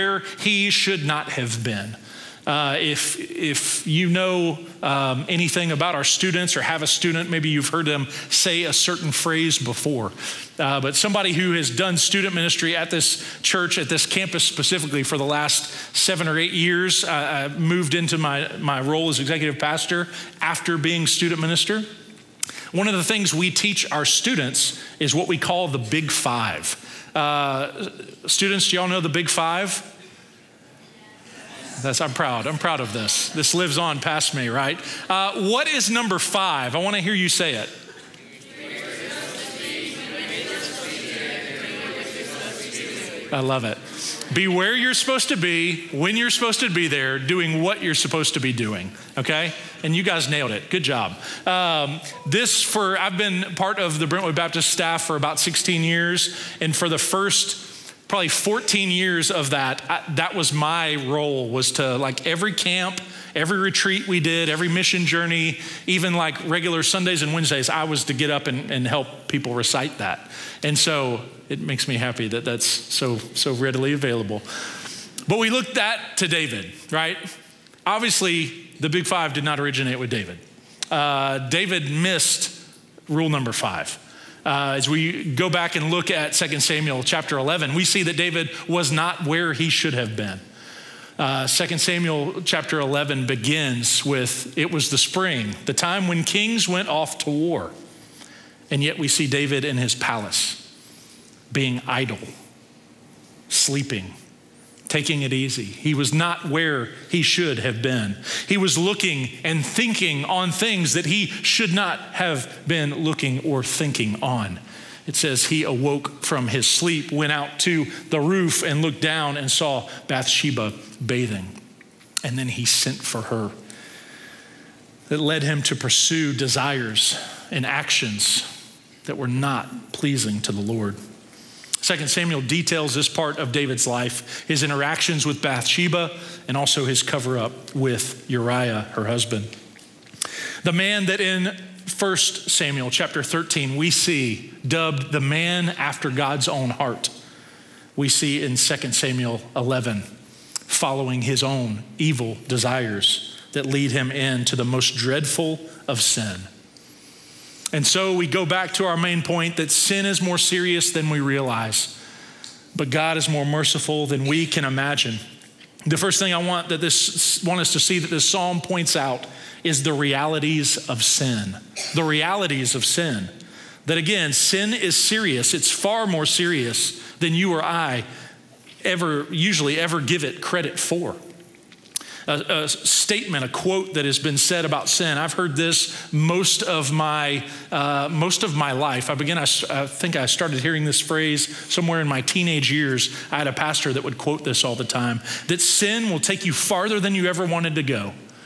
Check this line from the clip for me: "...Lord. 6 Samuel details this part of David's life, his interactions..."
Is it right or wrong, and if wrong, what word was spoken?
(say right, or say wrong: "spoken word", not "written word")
wrong: "2", not "6".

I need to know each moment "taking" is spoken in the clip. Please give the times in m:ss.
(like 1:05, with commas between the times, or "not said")
1:44.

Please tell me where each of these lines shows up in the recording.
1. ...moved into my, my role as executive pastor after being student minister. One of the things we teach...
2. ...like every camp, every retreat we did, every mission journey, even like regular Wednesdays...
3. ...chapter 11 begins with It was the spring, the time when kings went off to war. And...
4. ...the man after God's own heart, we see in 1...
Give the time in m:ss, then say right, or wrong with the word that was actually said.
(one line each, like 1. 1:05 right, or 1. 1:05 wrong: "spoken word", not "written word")
1. 0:17 right
2. 1:01 wrong: "Sundays", not "Wednesdays"
3. 1:32 right
4. 2:25 wrong: "2", not "1".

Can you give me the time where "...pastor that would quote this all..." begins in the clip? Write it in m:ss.
3:13.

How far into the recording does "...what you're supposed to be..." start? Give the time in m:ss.
0:47.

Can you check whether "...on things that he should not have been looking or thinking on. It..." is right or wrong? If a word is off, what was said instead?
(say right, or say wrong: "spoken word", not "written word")
right.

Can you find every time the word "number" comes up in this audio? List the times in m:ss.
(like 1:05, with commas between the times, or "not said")
0:35, 1:23.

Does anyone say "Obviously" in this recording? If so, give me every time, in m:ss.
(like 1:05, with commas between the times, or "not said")
1:17.